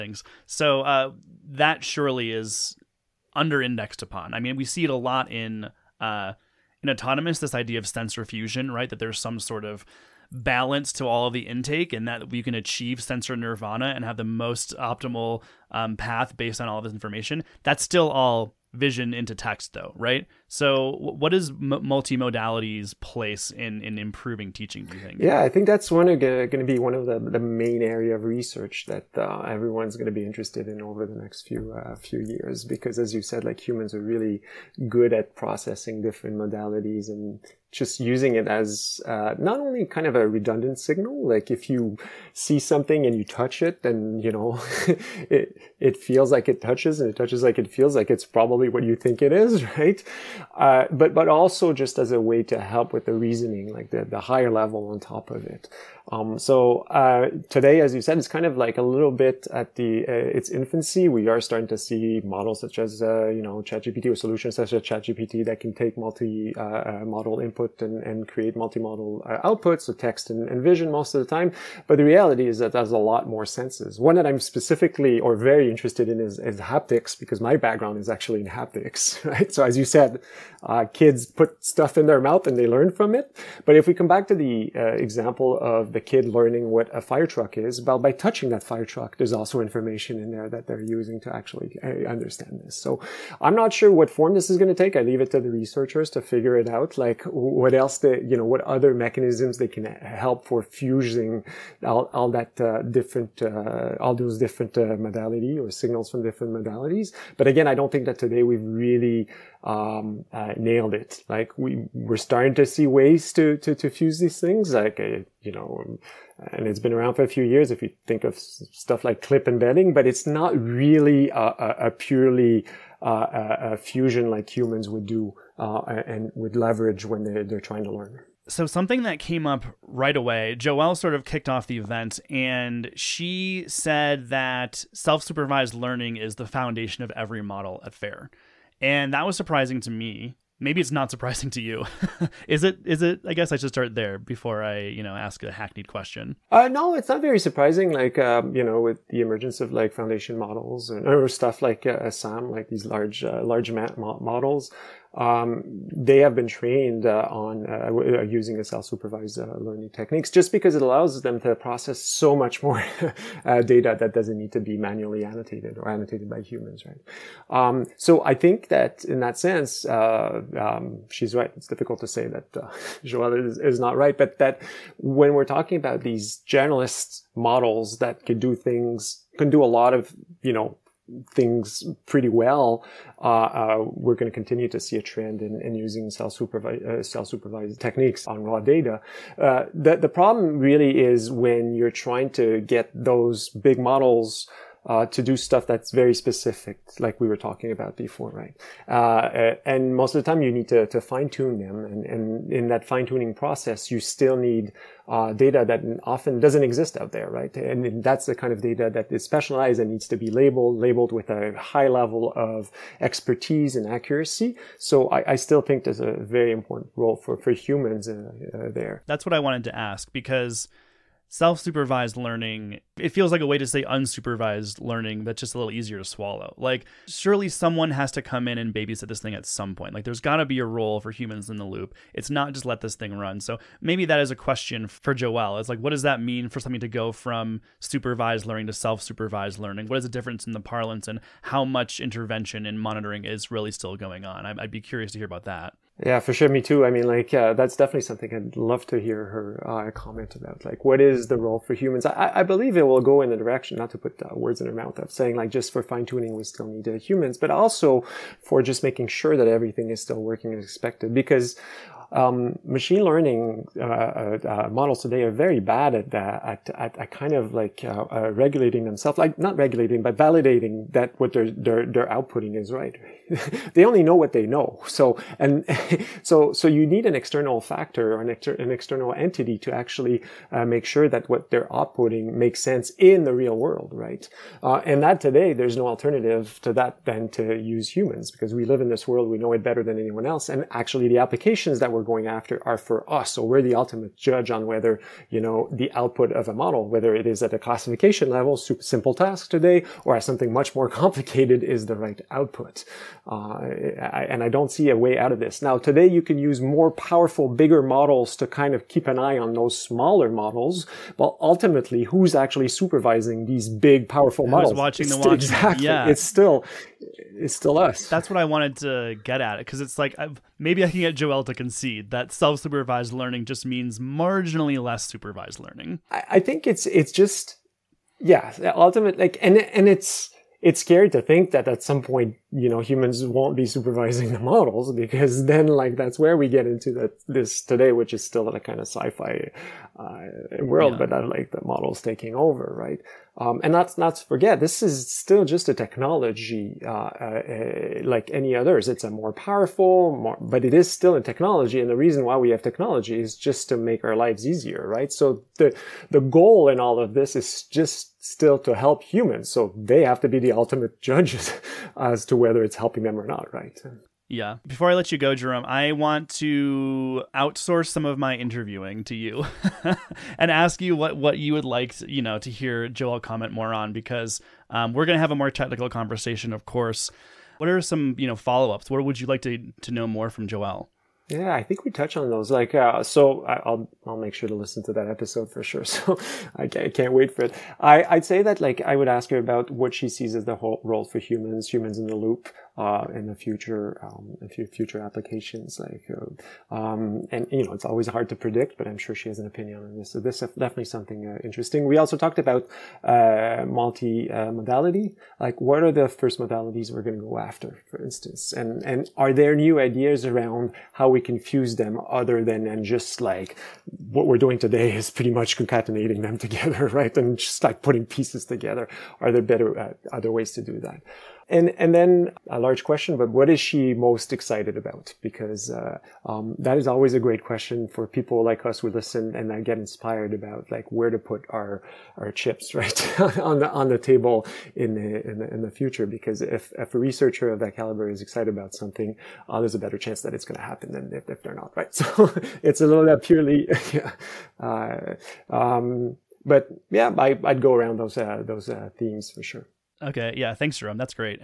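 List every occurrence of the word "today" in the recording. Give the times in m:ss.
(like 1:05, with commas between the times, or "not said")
0:57, 1:48, 4:25, 4:45, 4:59, 5:05, 5:37, 6:54.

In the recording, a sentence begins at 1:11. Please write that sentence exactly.
But the reality is that there's a lot more senses.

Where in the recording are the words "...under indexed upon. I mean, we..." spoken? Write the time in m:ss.
0:03.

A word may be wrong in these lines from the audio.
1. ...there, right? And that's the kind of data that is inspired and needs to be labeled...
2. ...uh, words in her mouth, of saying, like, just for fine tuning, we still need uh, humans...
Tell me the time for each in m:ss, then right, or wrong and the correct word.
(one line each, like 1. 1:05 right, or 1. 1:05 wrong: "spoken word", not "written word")
1. 3:27 wrong: "specialized", not "inspired"
2. 4:14 right.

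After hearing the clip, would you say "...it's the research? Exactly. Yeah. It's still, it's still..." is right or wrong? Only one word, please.
wrong.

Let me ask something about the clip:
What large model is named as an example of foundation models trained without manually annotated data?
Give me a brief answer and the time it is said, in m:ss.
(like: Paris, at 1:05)
SAM, at 2:32.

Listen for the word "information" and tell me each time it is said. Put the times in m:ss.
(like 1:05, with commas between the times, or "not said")
0:16, 1:29.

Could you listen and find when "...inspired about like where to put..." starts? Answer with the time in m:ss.
7:09.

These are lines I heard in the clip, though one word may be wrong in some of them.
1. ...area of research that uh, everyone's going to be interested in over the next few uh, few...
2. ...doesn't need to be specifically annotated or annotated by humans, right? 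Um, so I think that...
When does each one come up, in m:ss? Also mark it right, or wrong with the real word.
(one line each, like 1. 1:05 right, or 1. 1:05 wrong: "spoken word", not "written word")
1. 0:27 right
2. 2:44 wrong: "manually", not "specifically".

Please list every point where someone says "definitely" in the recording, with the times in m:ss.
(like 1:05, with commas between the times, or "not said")
4:07, 6:40.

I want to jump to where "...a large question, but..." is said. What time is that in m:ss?
7:02.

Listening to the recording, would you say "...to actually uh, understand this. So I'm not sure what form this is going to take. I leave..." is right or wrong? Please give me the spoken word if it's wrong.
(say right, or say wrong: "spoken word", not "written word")
right.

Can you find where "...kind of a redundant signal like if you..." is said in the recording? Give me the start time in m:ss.
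0:39.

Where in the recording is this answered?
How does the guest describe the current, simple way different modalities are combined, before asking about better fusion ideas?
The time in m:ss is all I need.
6:55.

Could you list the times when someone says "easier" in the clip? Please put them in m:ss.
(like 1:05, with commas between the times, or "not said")
3:45, 5:54.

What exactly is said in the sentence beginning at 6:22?
Like, uh, so I'll I'll make sure to listen to that episode for sure.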